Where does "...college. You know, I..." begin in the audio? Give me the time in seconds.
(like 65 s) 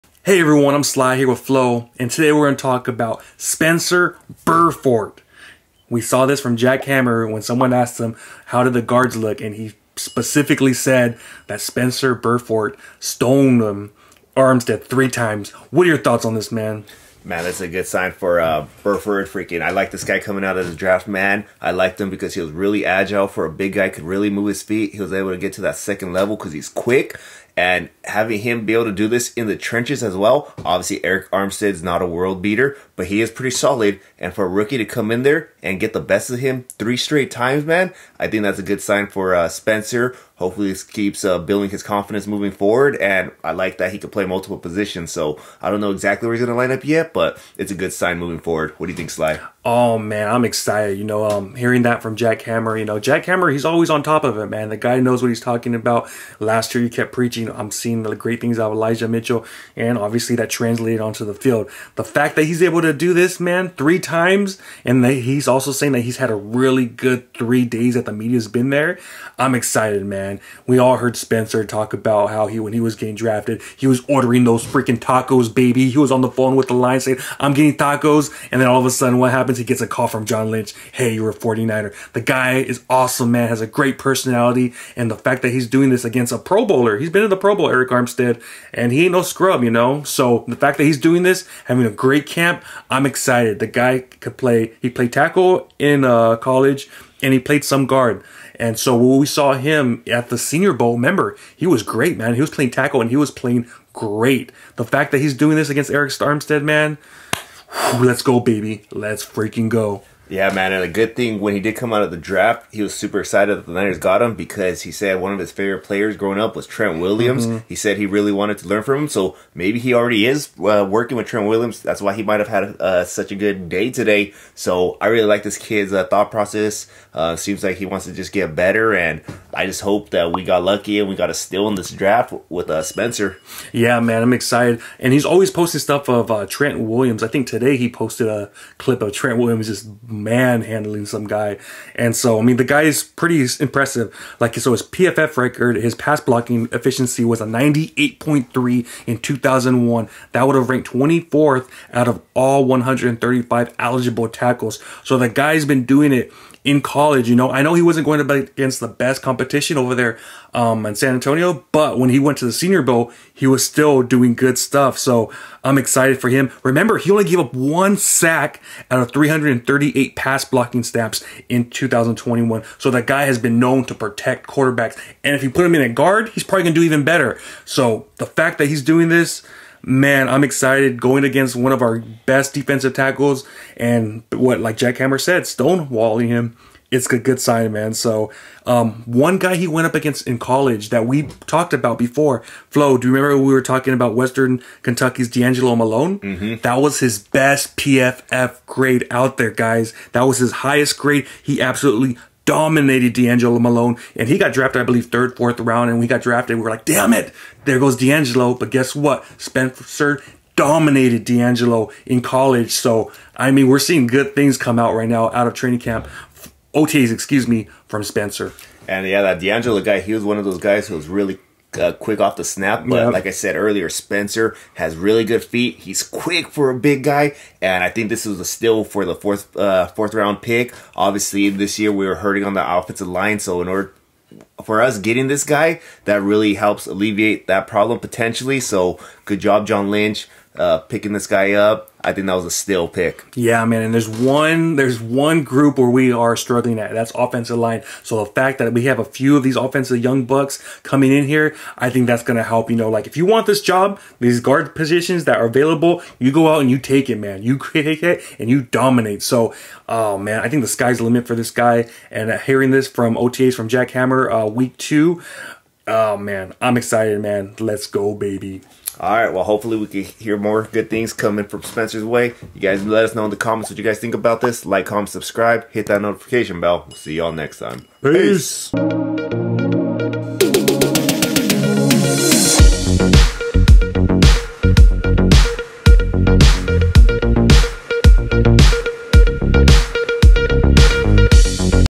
156 s.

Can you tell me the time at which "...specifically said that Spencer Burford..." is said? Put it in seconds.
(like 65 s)
9 s.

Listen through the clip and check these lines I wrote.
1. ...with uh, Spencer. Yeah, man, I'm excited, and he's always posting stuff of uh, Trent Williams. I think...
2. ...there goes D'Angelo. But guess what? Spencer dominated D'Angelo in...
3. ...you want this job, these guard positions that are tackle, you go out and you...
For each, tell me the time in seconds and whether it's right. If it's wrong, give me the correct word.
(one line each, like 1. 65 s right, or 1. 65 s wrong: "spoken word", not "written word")
1. 132 s right
2. 207 s right
3. 253 s wrong: "available", not "tackle".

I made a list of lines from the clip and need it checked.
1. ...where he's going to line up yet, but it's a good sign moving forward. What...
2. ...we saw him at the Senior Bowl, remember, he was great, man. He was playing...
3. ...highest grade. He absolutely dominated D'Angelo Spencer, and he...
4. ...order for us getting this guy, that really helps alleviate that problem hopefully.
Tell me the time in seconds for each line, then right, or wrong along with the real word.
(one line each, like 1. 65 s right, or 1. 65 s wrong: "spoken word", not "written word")
1. 46 s right
2. 99 s right
3. 200 s wrong: "Malone", not "Spencer"
4. 233 s wrong: "potentially", not "hopefully".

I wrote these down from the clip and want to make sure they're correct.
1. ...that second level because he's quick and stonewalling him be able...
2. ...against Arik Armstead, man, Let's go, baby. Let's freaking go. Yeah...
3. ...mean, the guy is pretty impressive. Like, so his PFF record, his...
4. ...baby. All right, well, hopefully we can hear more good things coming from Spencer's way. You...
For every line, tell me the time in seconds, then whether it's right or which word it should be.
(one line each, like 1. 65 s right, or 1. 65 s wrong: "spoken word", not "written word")
1. 25 s wrong: "having", not "stonewalling"
2. 105 s right
3. 142 s right
4. 268 s right.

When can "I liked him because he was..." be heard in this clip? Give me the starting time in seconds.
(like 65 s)
21 s.